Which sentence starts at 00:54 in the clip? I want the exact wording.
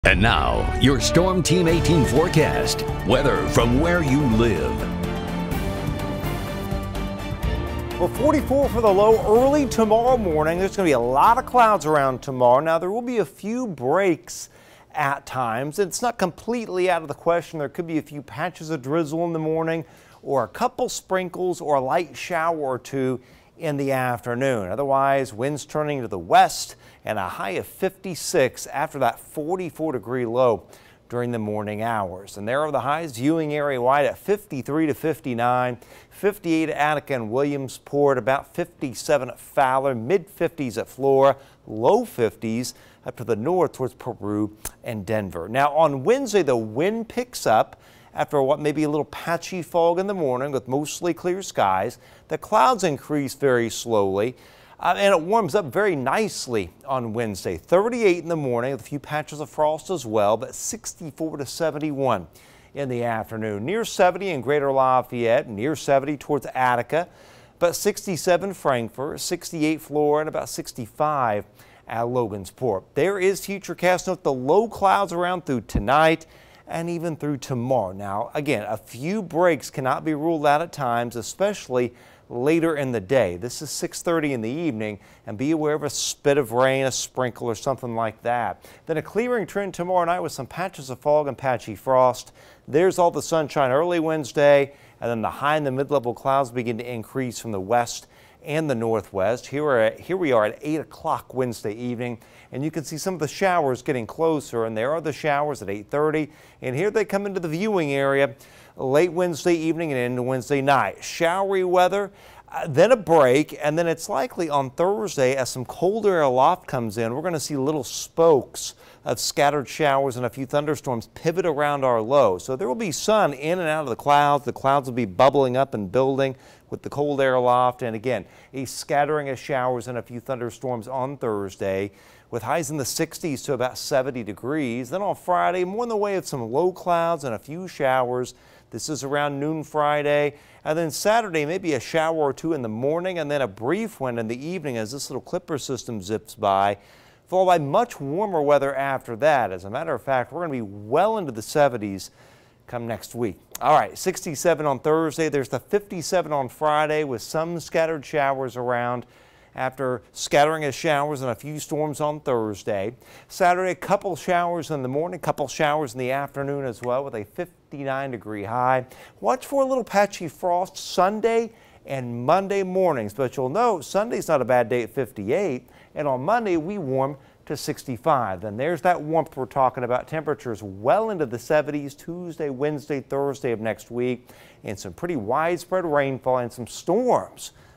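Uh, and it warms up very nicely on Wednesday.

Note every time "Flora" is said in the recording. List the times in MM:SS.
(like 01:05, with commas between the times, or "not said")
00:40, 01:09.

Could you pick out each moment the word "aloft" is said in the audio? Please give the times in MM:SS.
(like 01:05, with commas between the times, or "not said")
01:56, 02:07.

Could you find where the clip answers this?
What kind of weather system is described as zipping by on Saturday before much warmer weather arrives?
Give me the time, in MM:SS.
02:25.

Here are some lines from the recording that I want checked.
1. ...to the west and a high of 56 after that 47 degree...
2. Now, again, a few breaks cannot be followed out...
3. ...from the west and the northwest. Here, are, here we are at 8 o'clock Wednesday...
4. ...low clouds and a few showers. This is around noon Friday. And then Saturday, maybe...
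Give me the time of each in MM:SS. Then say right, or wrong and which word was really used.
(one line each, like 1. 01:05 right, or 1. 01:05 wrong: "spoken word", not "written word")
1. 00:26 wrong: "44", not "47"
2. 01:17 wrong: "ruled", not "followed"
3. 01:37 right
4. 02:16 right.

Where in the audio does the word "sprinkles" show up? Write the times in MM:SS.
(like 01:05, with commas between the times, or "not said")
00:20, 01:26.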